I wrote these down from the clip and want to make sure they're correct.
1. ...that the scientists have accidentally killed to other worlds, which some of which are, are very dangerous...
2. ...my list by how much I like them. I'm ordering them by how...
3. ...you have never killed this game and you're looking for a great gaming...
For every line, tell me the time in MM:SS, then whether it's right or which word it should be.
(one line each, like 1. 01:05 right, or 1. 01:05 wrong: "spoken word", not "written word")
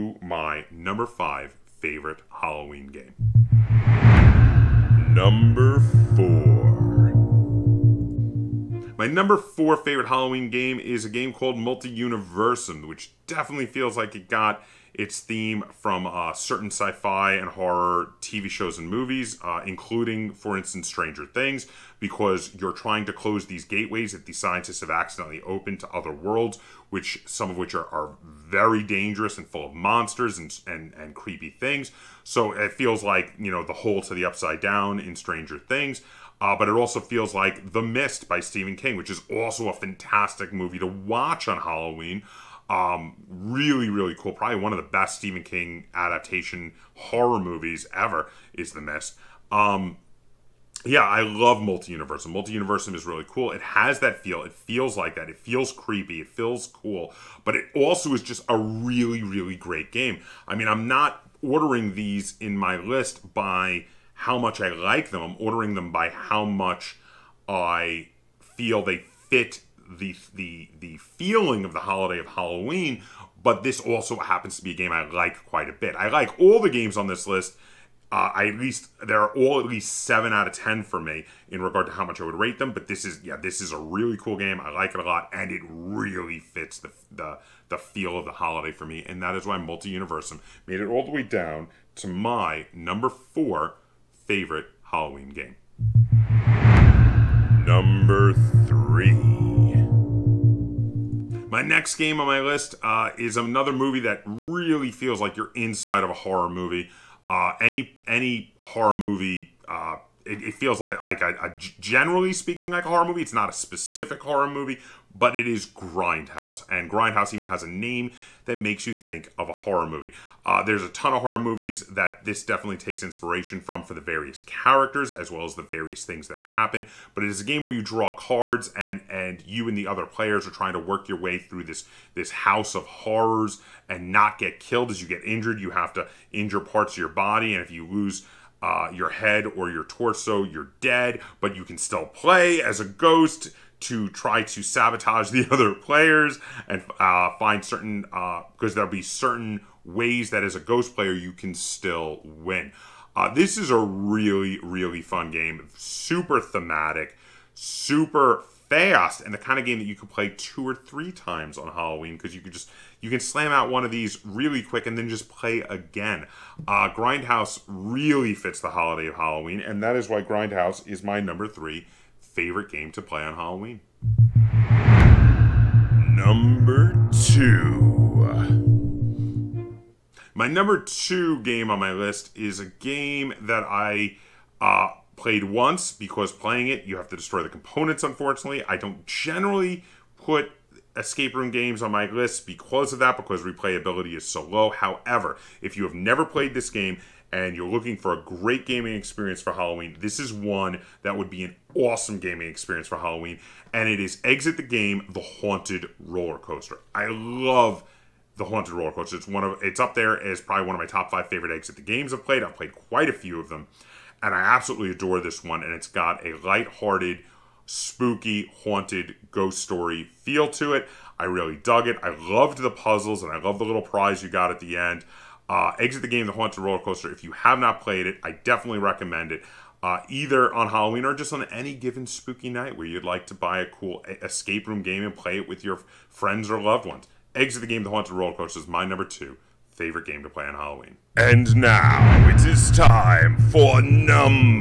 1. 00:24 wrong: "opened", not "killed"
2. 01:02 right
3. 03:15 wrong: "played", not "killed".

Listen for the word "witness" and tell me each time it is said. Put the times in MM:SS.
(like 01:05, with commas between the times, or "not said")
not said.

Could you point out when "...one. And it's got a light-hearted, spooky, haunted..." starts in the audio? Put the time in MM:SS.
03:35.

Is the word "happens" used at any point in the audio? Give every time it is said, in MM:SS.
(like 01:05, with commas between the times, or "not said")
01:14, 02:06.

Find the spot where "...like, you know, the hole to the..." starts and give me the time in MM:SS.
00:33.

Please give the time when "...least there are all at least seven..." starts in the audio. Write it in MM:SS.
01:18.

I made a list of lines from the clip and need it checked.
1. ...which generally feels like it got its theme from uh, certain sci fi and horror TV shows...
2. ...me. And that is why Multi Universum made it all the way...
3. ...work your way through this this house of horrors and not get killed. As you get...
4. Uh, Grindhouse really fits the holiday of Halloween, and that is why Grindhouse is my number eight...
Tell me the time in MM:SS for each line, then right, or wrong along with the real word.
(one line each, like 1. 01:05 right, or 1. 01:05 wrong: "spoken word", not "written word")
1. 00:12 wrong: "definitely", not "generally"
2. 01:28 right
3. 02:10 right
4. 02:46 wrong: "three", not "eight".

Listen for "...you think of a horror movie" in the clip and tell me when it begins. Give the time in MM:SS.
01:58.